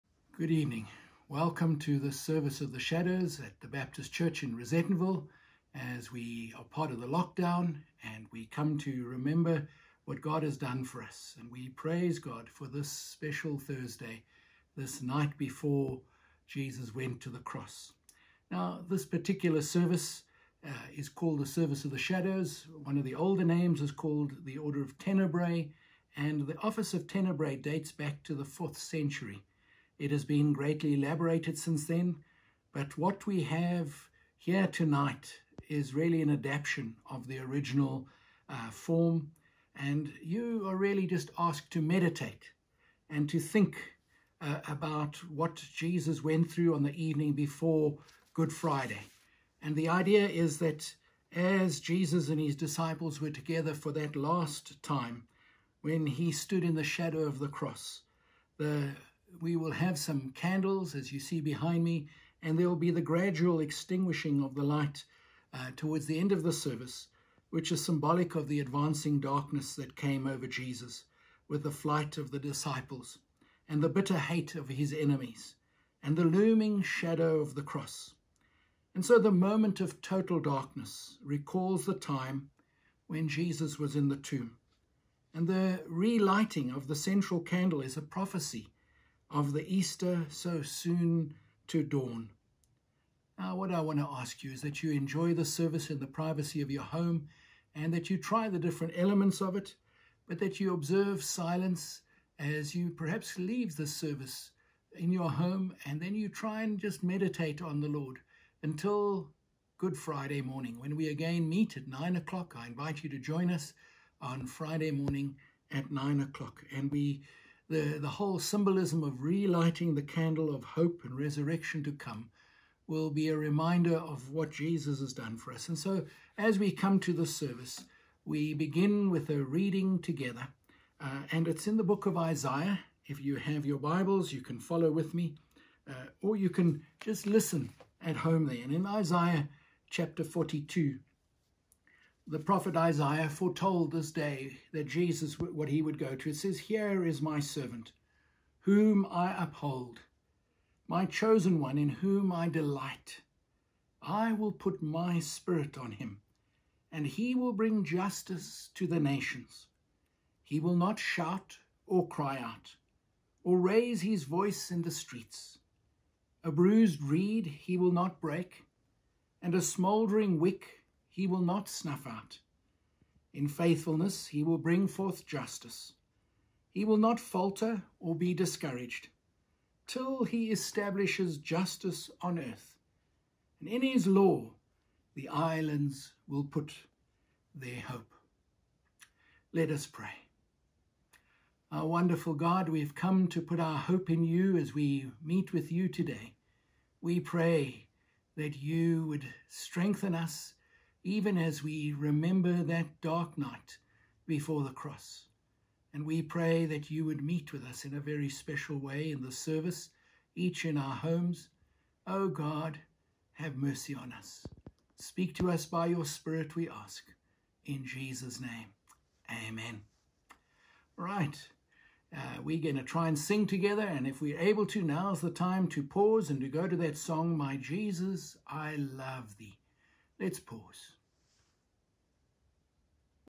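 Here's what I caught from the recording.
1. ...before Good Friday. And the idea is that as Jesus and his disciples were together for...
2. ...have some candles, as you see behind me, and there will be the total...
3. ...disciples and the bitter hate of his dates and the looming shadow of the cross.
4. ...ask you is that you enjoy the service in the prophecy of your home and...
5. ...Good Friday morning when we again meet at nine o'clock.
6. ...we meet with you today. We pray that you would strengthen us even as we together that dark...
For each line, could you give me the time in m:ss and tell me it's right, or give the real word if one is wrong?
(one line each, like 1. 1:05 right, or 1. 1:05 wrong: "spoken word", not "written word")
1. 0:47 right
2. 0:59 wrong: "gradual", not "total"
3. 1:12 wrong: "enemies", not "dates"
4. 1:34 wrong: "privacy", not "prophecy"
5. 1:49 right
6. 3:14 wrong: "remember", not "together".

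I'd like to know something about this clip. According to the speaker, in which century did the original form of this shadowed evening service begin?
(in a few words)
4th century.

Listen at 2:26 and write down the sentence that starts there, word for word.
It says, Here is my servant, whom I uphold, my chosen one, in whom I delight.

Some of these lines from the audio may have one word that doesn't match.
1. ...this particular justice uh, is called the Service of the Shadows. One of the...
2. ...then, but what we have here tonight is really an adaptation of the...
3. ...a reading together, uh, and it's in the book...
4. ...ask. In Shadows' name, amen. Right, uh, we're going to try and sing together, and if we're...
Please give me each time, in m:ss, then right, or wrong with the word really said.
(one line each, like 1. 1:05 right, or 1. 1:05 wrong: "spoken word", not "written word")
1. 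0:18 wrong: "service", not "justice"
2. 0:31 right
3. 2:09 right
4. 3:36 wrong: "Jesus", not "Shadows".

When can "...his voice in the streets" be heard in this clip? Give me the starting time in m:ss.
2:44.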